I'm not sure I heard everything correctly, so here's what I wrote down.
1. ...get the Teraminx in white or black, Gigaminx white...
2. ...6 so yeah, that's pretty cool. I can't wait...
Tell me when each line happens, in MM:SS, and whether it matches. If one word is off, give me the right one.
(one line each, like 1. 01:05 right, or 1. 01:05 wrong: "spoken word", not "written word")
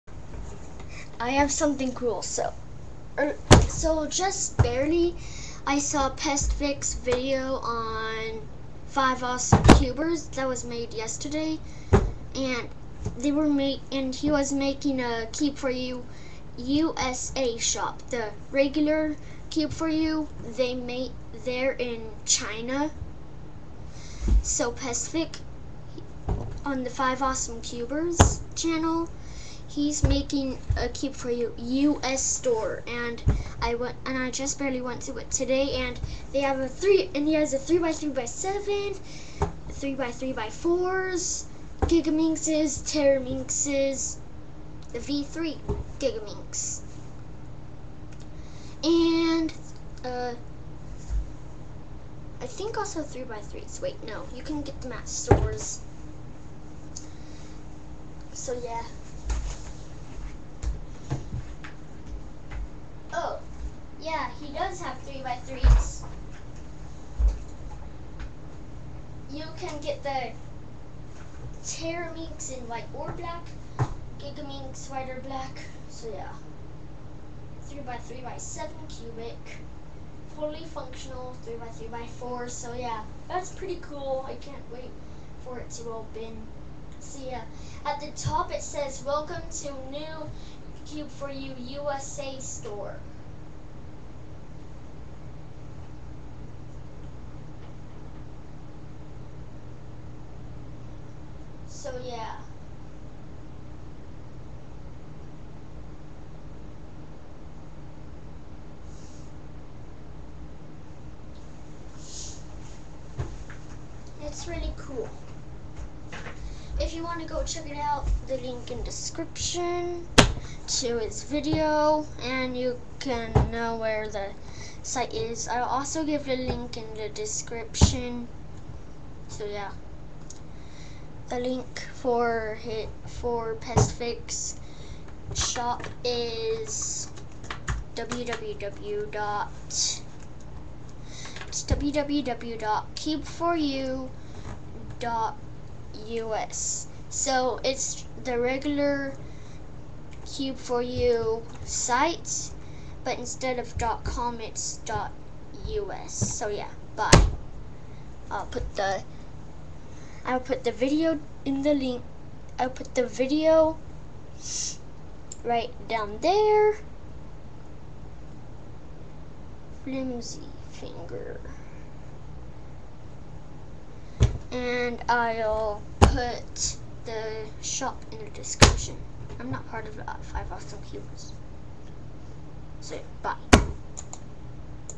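1. 01:09 right
2. 01:22 wrong: "4", not "6".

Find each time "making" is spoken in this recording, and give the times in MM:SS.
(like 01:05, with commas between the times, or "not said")
00:14, 00:30.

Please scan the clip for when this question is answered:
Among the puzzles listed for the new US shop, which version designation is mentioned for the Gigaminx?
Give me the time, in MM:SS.
00:44.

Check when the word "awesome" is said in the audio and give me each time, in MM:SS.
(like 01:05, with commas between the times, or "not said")
00:09, 00:27, 03:00.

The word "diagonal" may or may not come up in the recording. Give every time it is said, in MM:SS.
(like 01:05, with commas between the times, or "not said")
not said.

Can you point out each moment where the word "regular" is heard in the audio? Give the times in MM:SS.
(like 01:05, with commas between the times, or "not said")
00:18, 02:28.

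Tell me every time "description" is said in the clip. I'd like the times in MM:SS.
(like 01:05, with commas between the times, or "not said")
01:58, 02:07, 02:58.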